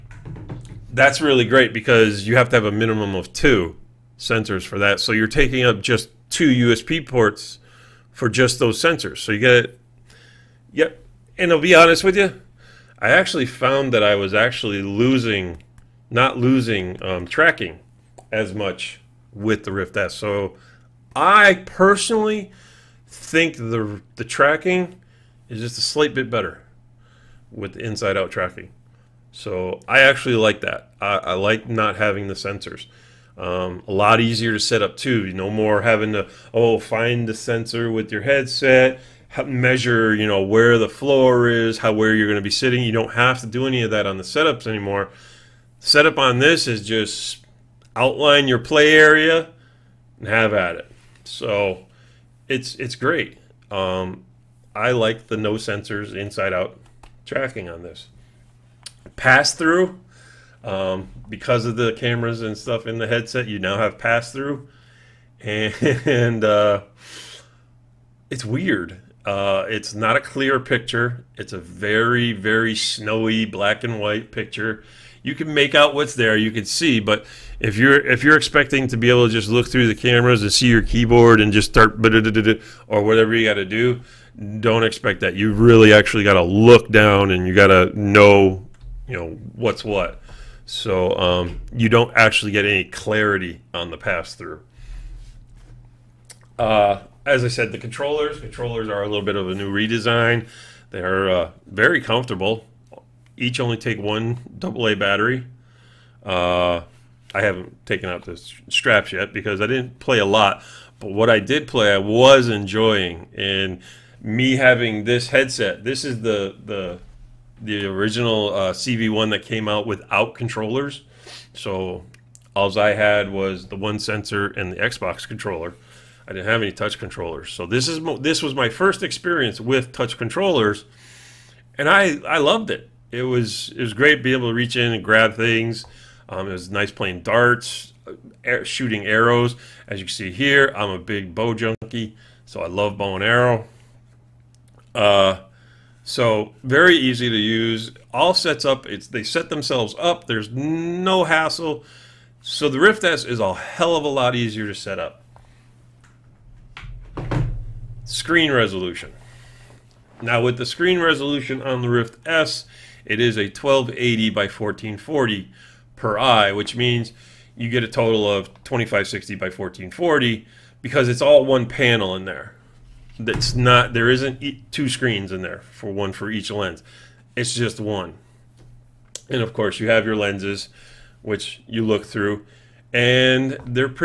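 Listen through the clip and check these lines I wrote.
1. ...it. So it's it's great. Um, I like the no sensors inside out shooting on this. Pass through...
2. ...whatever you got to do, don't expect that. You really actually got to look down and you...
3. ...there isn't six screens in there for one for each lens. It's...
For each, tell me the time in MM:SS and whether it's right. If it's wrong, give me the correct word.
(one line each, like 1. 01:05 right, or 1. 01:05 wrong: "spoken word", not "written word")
1. 00:50 wrong: "tracking", not "shooting"
2. 01:23 right
3. 02:53 wrong: "two", not "six".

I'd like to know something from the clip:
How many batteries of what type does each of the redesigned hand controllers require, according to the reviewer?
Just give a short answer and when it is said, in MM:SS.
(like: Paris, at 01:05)
1 AA, at 01:43.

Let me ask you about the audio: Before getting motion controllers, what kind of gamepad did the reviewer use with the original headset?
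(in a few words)
Xbox controller.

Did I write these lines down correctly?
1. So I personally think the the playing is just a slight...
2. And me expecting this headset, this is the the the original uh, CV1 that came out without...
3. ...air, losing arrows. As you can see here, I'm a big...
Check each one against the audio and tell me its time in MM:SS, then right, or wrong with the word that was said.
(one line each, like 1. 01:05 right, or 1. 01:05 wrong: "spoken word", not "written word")
1. 00:20 wrong: "tracking", not "playing"
2. 01:53 wrong: "having", not "expecting"
3. 02:18 wrong: "shooting", not "losing".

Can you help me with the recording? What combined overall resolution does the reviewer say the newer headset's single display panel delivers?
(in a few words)
2560 by 1440.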